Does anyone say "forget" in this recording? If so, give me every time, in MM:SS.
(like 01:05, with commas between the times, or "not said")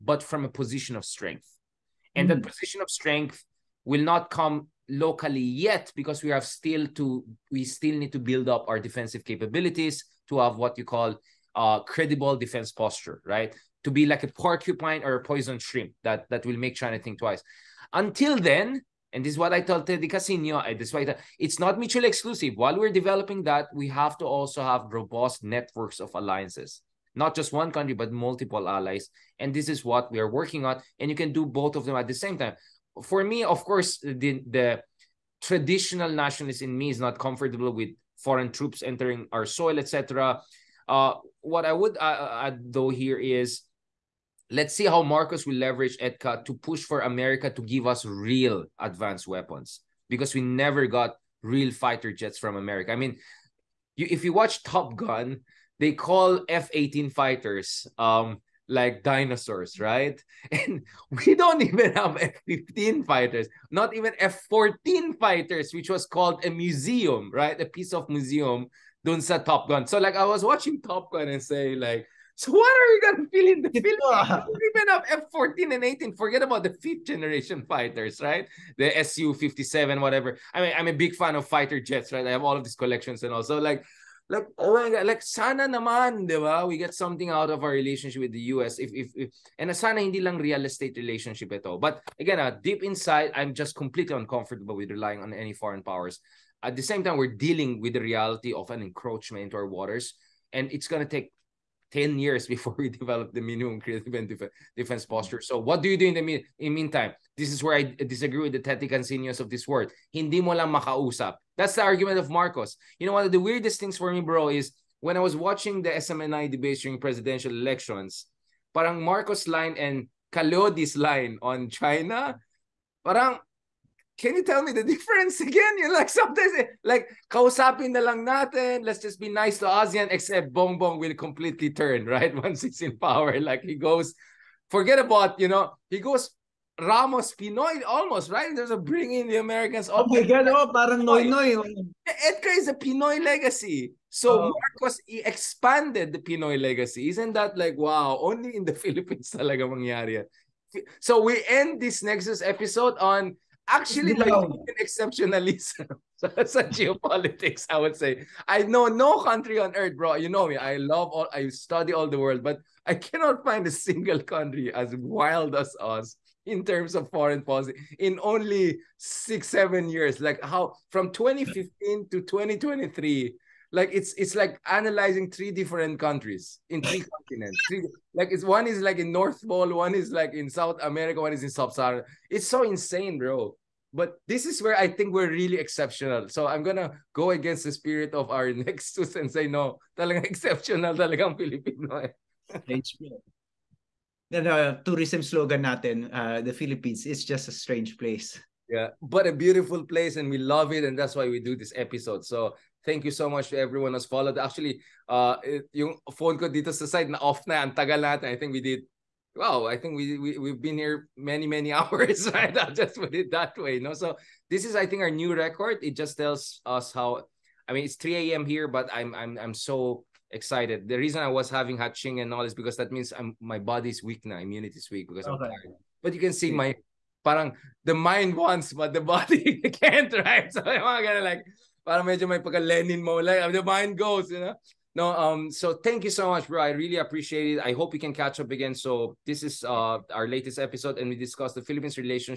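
01:16, 02:14.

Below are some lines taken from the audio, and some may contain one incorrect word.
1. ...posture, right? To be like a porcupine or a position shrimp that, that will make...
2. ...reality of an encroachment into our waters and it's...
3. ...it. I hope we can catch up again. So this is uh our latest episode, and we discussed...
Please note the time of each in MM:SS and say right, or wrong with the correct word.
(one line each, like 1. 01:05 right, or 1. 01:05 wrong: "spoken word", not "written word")
1. 00:12 wrong: "poison", not "position"
2. 01:38 right
3. 03:57 right.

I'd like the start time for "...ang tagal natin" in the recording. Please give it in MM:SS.
03:27.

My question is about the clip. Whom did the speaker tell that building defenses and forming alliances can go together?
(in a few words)
Teddy Casiño.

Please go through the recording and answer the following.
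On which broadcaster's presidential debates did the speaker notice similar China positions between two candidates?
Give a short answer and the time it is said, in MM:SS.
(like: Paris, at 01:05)
SMNI, at 01:56.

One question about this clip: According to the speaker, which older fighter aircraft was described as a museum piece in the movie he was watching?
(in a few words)
F-14.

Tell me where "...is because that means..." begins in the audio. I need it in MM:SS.
03:42.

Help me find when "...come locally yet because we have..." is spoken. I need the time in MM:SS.
00:04.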